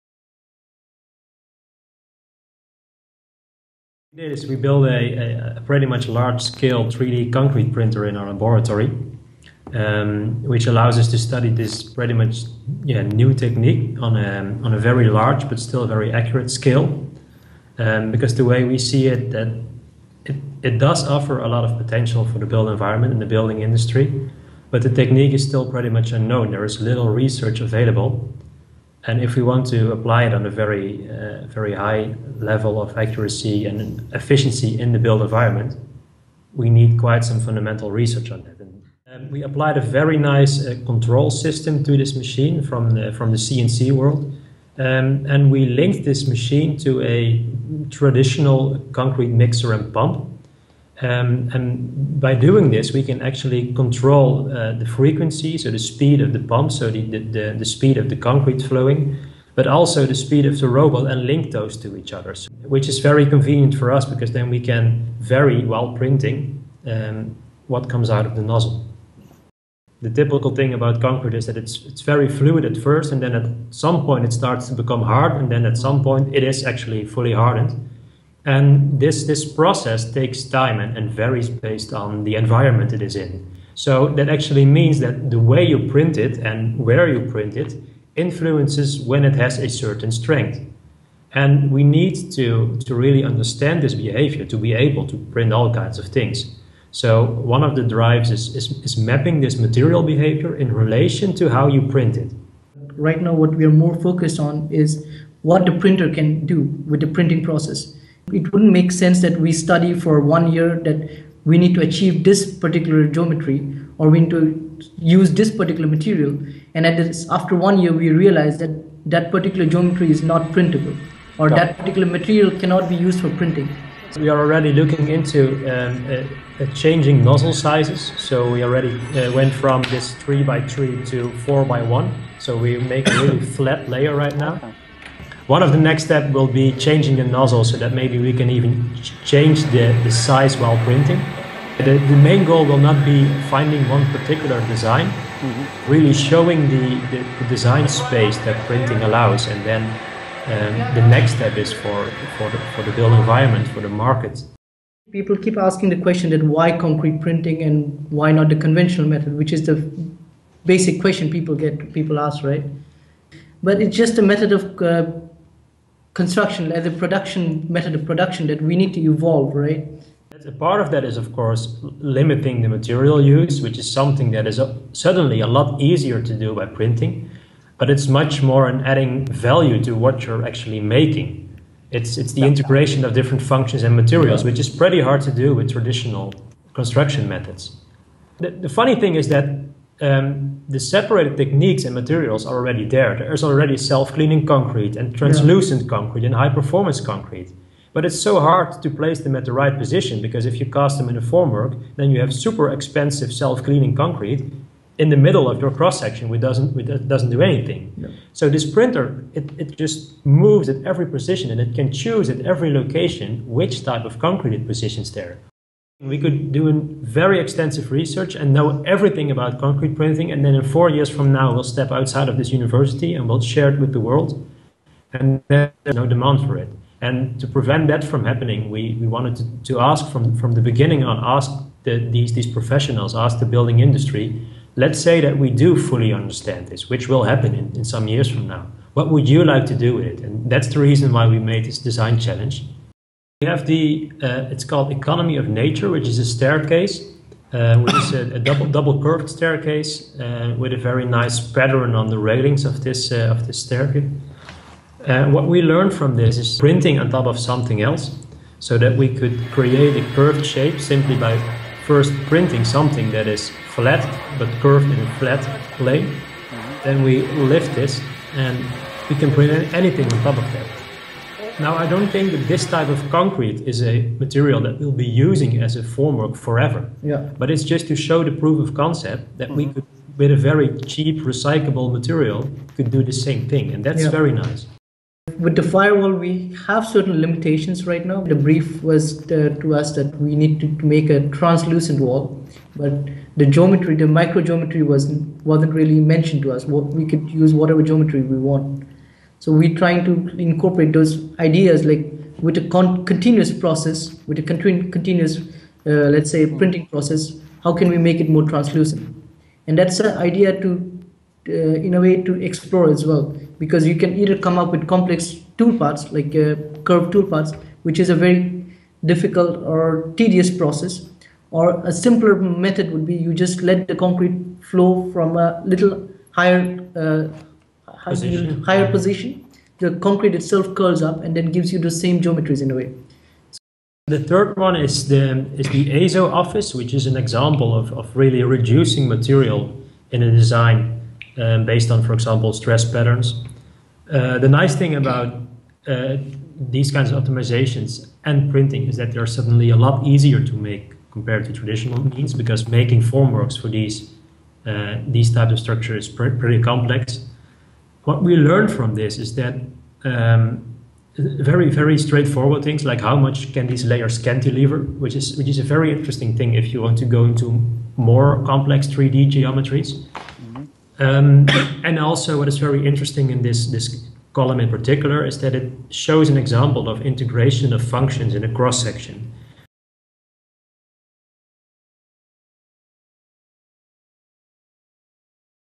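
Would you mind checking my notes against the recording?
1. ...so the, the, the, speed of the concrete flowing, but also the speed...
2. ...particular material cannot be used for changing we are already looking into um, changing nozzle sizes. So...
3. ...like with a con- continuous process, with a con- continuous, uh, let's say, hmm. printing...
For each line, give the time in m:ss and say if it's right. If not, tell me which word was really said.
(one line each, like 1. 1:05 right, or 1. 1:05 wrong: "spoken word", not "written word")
1. 0:56 right
2. 2:01 wrong: "printing", not "changing"
3. 5:01 right.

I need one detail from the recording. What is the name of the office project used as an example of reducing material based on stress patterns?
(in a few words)
ASO office.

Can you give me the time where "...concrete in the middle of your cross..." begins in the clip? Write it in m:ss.
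3:23.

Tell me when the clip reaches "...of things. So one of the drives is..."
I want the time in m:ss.
1:35.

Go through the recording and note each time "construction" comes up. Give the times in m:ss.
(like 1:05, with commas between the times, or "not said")
2:46, 3:06.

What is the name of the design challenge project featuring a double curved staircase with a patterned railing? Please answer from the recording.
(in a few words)
Economy of Nature.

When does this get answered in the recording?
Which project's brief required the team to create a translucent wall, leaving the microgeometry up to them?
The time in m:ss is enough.
4:45.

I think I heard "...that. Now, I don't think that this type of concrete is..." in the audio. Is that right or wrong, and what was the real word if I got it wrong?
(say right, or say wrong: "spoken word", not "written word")
right.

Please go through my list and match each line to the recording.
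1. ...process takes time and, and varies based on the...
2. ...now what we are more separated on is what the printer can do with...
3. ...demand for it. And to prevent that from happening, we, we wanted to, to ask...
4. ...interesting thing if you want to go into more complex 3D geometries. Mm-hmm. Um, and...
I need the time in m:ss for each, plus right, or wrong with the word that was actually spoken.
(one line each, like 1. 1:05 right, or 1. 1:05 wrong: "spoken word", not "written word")
1. 1:19 right
2. 1:43 wrong: "focused", not "separated"
3. 3:46 right
4. 6:05 right.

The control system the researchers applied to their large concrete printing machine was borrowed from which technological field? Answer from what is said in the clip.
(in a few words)
CNC world.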